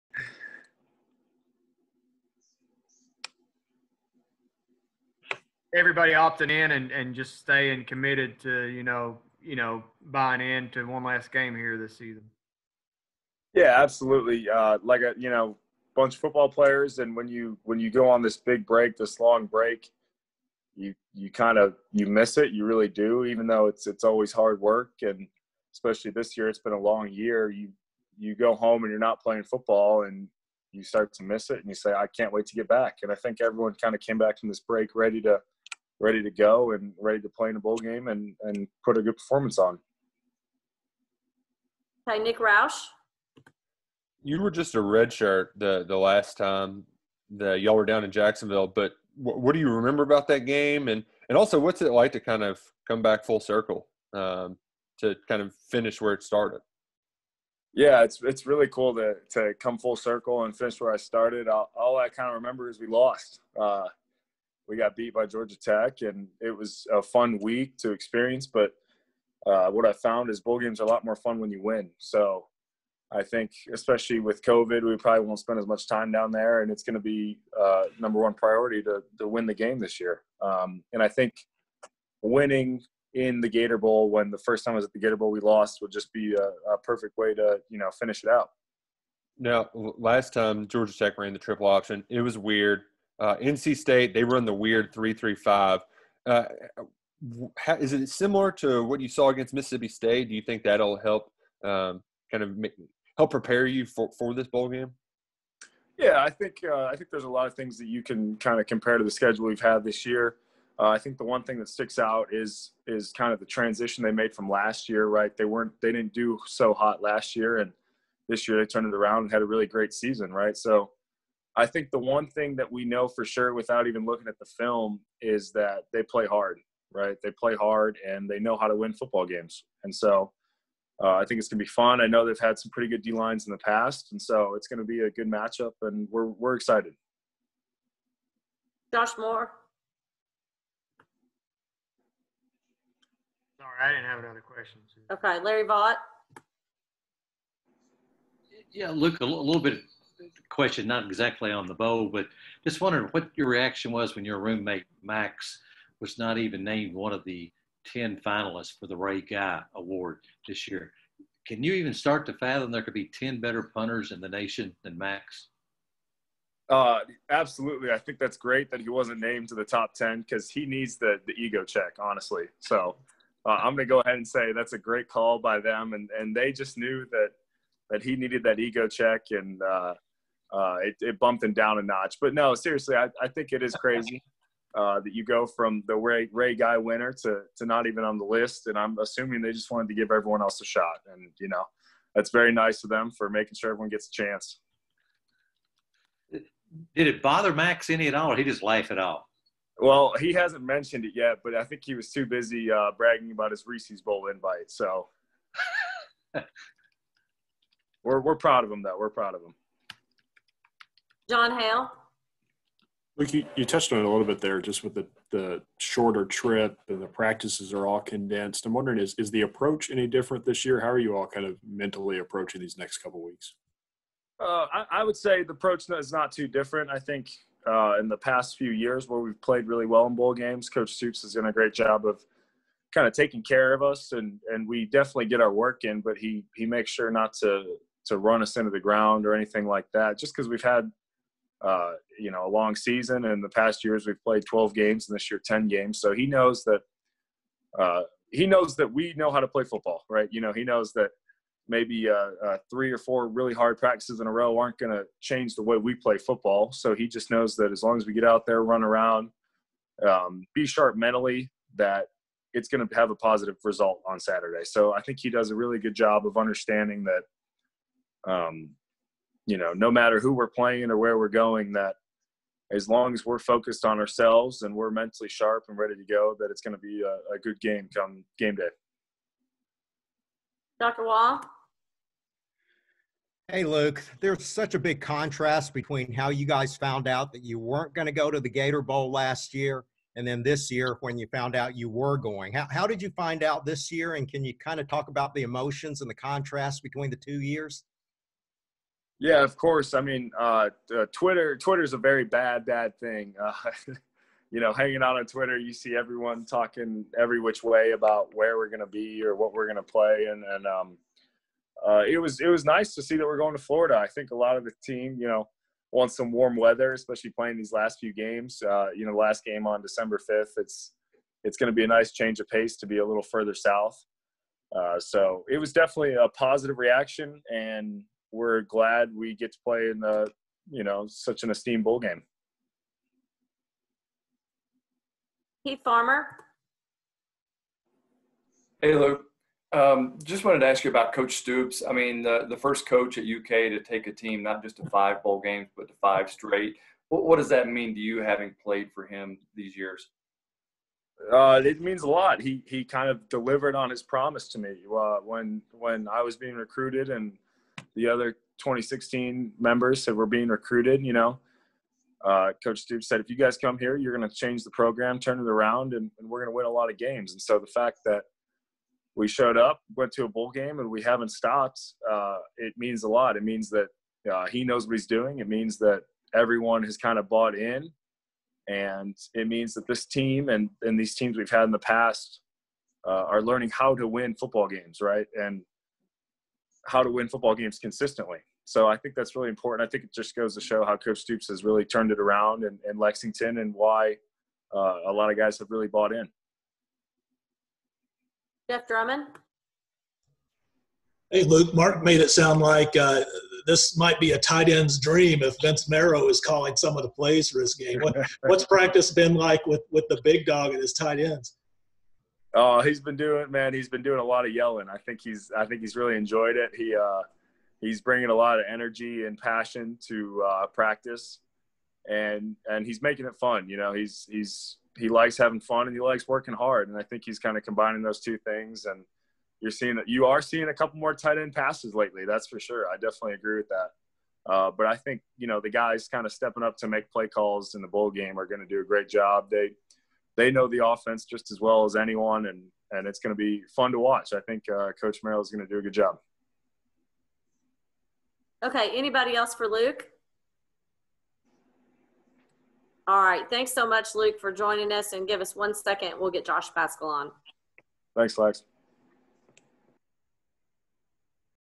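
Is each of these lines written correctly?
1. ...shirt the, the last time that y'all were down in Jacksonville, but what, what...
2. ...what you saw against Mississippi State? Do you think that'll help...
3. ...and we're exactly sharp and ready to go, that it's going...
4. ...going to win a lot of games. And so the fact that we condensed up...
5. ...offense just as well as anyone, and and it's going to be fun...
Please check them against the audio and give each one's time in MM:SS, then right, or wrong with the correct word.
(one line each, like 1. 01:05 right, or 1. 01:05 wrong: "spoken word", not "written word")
1. 00:45 right
2. 01:38 right
3. 04:34 wrong: "mentally", not "exactly"
4. 06:06 wrong: "showed", not "condensed"
5. 07:20 right.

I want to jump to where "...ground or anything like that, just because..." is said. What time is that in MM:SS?
03:58.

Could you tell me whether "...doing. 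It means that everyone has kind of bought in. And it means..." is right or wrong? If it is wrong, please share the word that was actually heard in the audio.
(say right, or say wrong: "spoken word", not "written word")
right.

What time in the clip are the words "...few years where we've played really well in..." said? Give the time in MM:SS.
03:48.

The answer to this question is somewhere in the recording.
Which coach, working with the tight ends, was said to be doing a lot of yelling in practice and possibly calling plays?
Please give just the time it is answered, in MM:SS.
06:45.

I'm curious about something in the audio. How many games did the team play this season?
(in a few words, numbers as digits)
10.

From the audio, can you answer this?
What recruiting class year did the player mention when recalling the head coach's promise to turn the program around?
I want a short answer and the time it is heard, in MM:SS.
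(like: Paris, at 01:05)
2016, at 05:58.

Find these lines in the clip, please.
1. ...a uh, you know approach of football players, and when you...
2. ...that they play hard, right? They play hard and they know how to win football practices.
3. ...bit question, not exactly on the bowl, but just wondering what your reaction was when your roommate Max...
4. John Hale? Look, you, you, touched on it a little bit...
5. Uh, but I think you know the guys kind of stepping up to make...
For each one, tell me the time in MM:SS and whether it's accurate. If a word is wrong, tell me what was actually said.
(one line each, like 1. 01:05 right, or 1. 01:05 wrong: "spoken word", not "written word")
1. 00:15 wrong: "bunch", not "approach"
2. 02:05 wrong: "games", not "practices"
3. 02:29 right
4. 03:31 right
5. 07:14 right.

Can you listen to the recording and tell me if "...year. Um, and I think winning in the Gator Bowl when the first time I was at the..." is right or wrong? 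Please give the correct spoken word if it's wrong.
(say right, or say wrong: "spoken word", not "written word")
right.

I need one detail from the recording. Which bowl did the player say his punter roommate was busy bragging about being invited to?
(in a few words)
Reese's Bowl.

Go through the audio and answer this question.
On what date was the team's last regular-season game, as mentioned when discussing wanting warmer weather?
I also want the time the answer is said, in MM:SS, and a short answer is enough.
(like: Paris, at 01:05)
December 5, at 05:19.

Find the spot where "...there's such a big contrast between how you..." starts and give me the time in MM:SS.
04:44.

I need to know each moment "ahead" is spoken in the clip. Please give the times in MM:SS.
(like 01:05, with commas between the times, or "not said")
02:54.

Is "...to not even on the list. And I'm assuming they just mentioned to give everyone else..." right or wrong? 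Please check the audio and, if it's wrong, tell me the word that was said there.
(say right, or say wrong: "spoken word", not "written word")
wrong: "wanted", not "mentioned".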